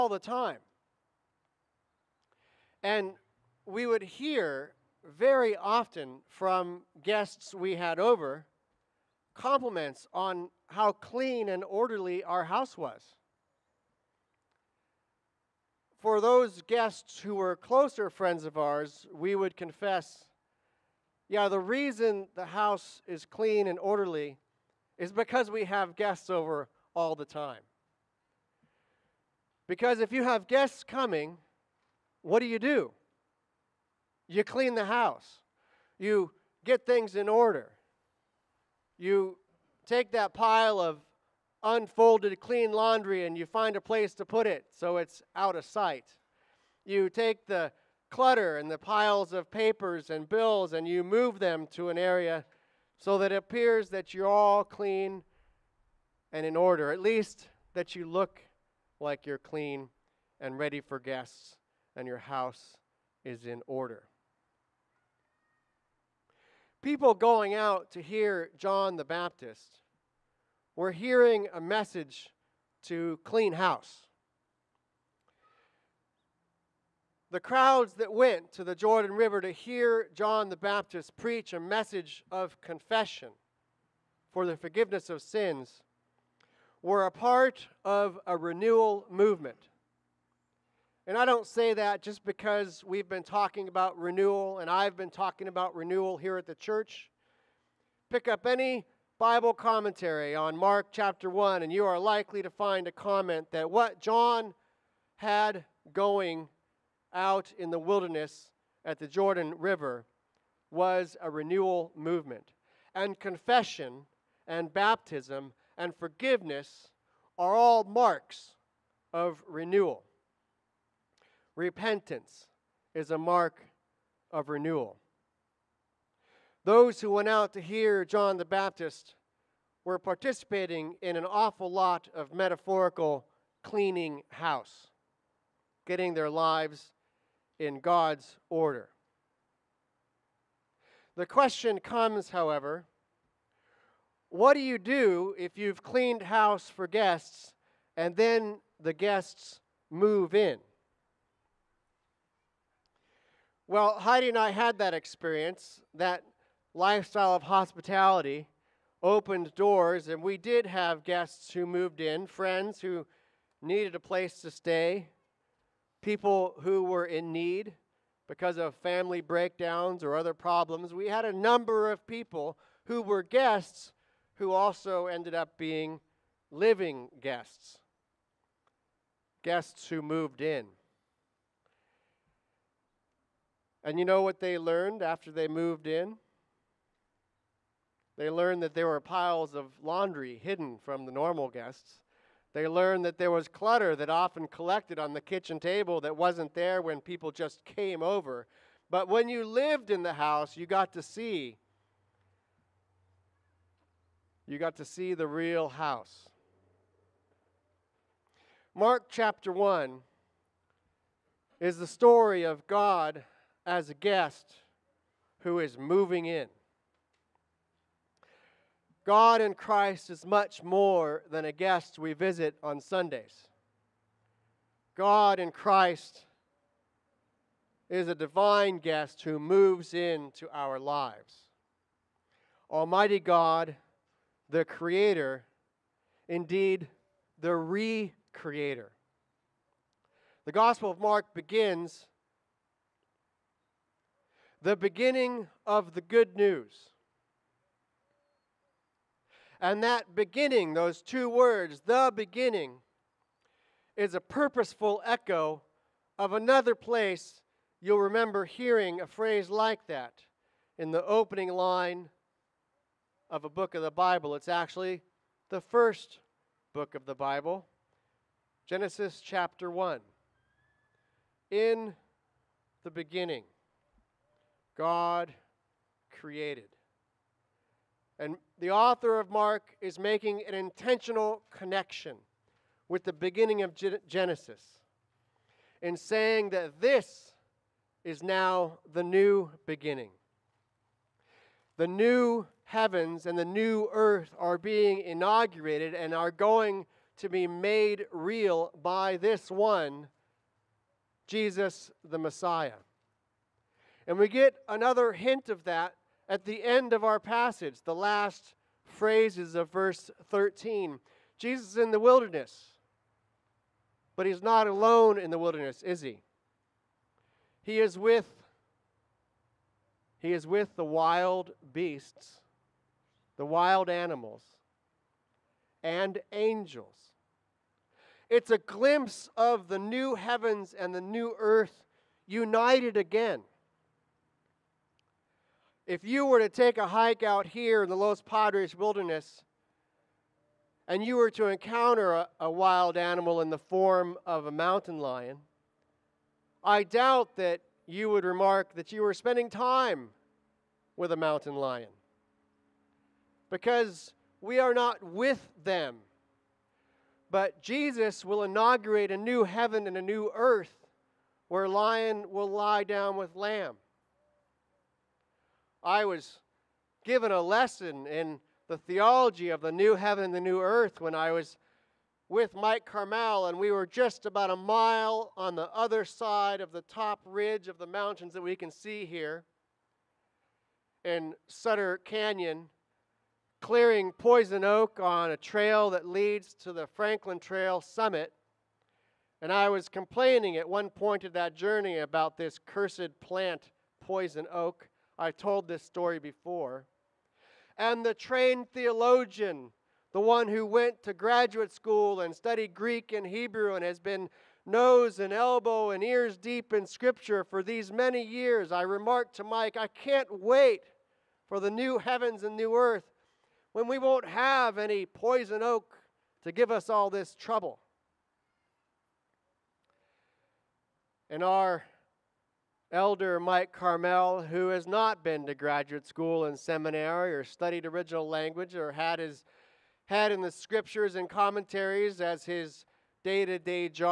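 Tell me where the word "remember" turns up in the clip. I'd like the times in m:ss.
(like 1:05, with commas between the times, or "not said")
4:18.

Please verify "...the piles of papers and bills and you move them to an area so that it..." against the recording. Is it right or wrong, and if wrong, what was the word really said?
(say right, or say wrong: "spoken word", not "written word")
right.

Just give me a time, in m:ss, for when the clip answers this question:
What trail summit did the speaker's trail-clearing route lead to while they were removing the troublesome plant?
6:26.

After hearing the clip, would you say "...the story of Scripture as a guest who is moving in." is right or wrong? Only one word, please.
wrong.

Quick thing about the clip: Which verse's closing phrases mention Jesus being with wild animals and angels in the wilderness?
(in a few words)
Verse 13.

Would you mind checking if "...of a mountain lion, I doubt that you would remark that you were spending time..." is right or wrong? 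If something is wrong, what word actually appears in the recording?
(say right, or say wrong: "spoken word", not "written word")
right.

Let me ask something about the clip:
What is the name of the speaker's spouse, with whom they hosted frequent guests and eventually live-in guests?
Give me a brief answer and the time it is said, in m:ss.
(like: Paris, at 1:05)
Heidi, at 2:33.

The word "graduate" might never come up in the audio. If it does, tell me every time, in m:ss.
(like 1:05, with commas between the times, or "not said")
6:41, 7:05.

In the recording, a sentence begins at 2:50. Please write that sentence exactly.
We had a number of people who were guests who also ended up being living guests, guests who moved in.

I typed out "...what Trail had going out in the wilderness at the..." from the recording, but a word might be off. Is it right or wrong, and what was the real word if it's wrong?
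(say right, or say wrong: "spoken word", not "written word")
wrong: "John", not "Trail".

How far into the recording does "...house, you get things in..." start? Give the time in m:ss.
0:34.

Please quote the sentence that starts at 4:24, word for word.
It's actually the first book of the Bible, Genesis chapter 1.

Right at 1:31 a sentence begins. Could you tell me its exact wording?
And I don't say that just because we've been talking about renewal and I've been talking about renewal here at the church.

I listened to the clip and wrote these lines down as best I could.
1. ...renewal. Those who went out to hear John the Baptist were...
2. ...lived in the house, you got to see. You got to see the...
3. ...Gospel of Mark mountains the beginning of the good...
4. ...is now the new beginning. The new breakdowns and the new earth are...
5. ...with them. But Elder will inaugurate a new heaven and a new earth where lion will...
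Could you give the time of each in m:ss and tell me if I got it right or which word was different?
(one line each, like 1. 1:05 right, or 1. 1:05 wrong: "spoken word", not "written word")
1. 2:04 right
2. 3:19 right
3. 4:00 wrong: "begins", not "mountains"
4. 4:48 wrong: "heavens", not "breakdowns"
5. 5:55 wrong: "Jesus", not "Elder".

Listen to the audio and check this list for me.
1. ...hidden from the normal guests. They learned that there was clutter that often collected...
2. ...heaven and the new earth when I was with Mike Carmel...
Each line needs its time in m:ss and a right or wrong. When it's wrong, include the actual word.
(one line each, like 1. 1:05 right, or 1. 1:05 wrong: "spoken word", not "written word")
1. 3:10 right
2. 6:09 right.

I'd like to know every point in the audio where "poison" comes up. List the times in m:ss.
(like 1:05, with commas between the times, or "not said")
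6:24, 6:33, 6:55.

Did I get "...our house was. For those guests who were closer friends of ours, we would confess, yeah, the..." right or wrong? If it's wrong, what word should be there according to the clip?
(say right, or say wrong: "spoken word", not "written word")
right.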